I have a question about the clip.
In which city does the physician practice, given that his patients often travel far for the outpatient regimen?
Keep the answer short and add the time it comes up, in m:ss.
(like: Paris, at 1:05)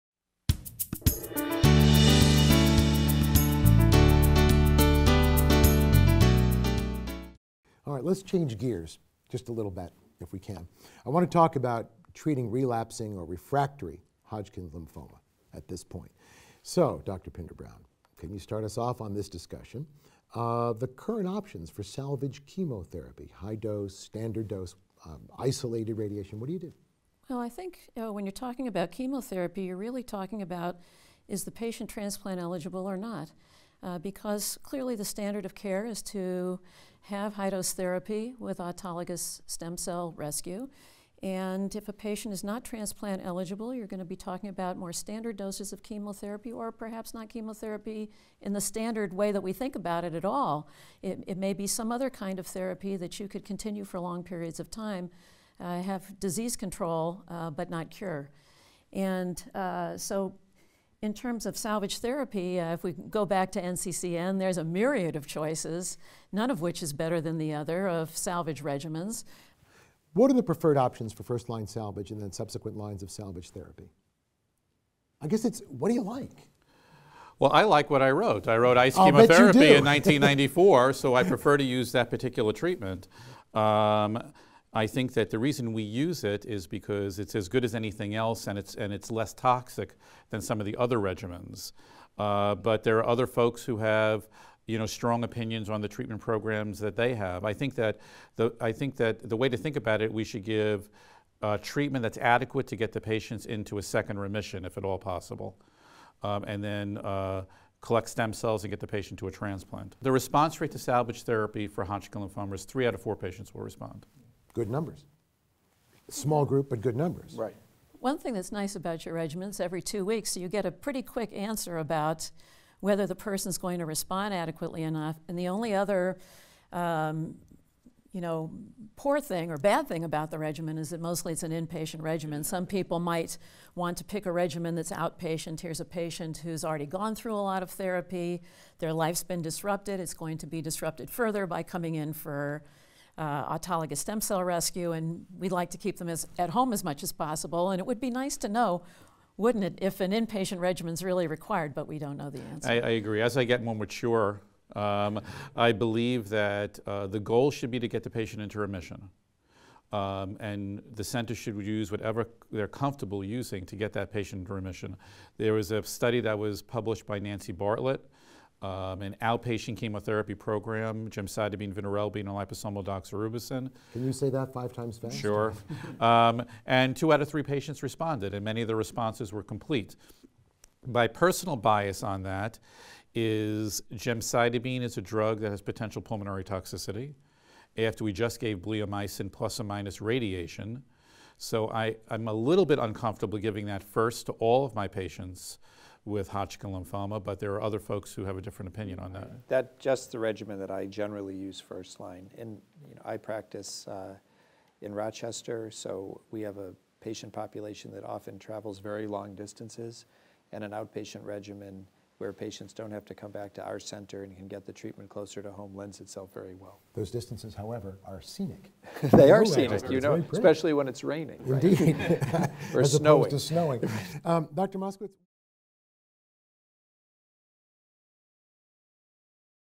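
Rochester, at 3:24.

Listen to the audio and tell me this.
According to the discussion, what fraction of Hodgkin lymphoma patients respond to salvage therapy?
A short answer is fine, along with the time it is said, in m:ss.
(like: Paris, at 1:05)
three out of four, at 1:52.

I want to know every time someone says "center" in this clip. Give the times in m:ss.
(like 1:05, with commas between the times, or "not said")
2:41, 3:33.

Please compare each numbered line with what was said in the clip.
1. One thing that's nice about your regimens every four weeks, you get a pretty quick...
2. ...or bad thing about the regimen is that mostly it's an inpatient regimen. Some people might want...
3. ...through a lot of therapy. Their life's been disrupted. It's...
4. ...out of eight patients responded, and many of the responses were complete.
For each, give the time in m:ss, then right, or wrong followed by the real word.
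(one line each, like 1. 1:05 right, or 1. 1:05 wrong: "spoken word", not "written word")
1. 1:57 wrong: "two", not "four"
2. 2:09 right
3. 2:17 right
4. 2:57 wrong: "three", not "eight".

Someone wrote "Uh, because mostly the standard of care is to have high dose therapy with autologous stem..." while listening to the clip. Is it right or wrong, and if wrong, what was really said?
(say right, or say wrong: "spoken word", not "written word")
wrong: "clearly", not "mostly".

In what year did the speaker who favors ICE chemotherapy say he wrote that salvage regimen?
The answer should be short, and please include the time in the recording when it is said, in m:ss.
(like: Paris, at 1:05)
1994, at 1:19.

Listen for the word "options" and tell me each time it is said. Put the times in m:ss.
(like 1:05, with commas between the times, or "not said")
0:21, 1:10.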